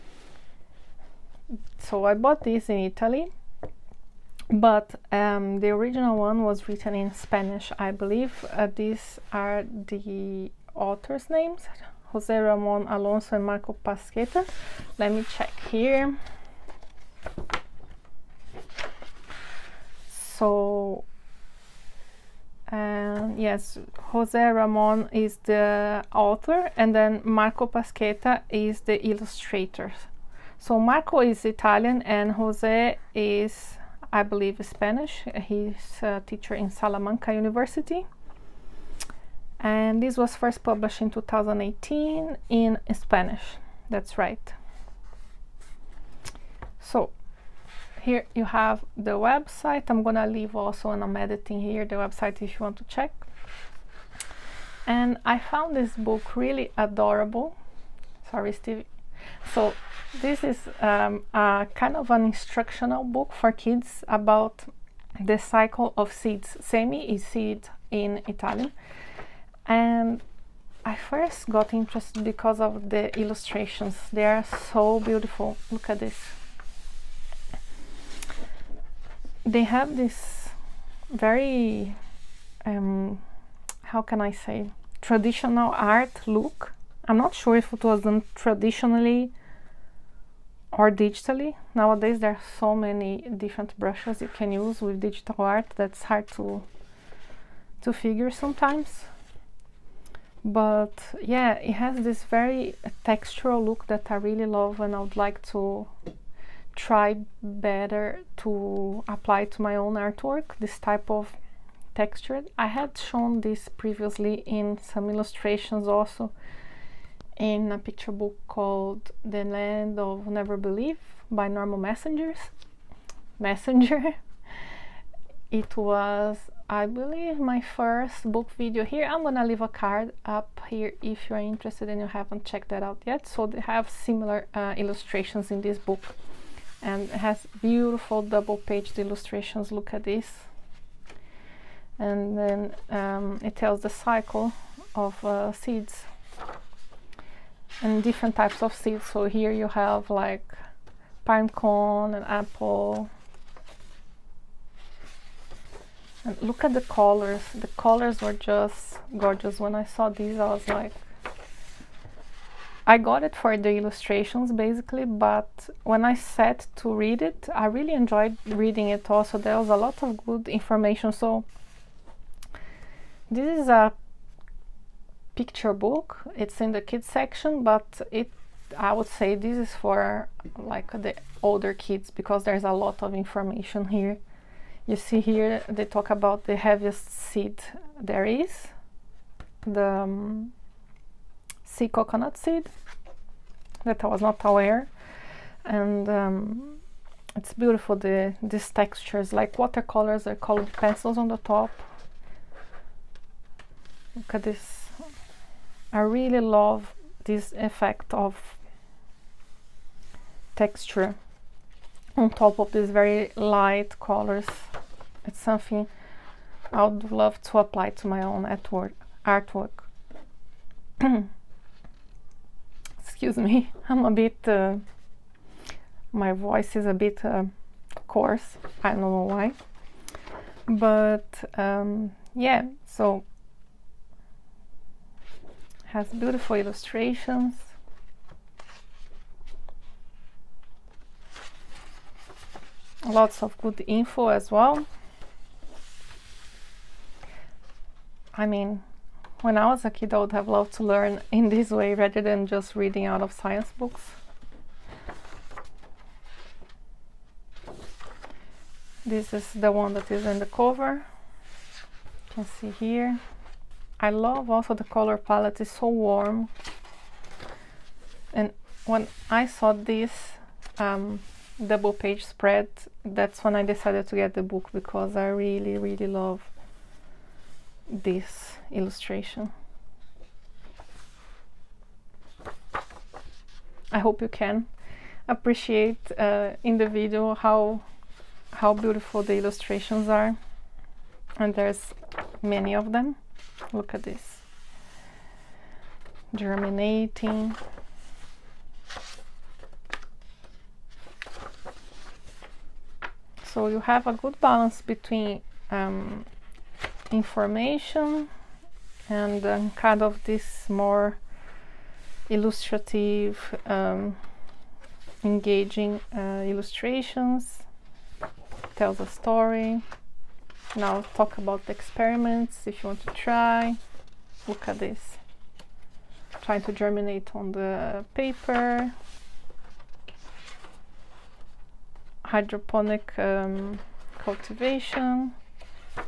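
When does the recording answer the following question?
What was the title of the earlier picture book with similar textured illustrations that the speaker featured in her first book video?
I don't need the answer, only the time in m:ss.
1:59.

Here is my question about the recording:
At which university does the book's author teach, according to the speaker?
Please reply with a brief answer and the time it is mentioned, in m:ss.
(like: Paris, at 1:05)
Salamanca University, at 0:36.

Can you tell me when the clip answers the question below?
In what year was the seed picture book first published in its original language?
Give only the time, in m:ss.
0:41.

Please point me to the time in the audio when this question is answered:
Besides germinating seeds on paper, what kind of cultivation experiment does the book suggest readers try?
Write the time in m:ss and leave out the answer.
5:32.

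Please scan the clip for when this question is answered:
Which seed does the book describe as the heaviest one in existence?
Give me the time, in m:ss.
3:11.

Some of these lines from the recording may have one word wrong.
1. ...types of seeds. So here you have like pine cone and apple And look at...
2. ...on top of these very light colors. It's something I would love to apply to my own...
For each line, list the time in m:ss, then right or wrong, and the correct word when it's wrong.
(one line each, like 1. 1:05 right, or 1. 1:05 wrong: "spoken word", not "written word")
1. 2:28 right
2. 3:32 right.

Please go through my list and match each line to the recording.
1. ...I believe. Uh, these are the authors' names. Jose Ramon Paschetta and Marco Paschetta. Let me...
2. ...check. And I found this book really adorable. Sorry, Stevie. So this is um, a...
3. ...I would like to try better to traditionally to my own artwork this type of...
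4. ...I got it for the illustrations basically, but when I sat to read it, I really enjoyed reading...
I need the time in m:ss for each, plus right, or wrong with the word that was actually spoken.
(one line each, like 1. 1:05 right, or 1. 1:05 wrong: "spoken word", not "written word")
1. 0:07 wrong: "Alonso", not "Paschetta"
2. 0:52 right
3. 1:44 wrong: "apply", not "traditionally"
4. 2:42 right.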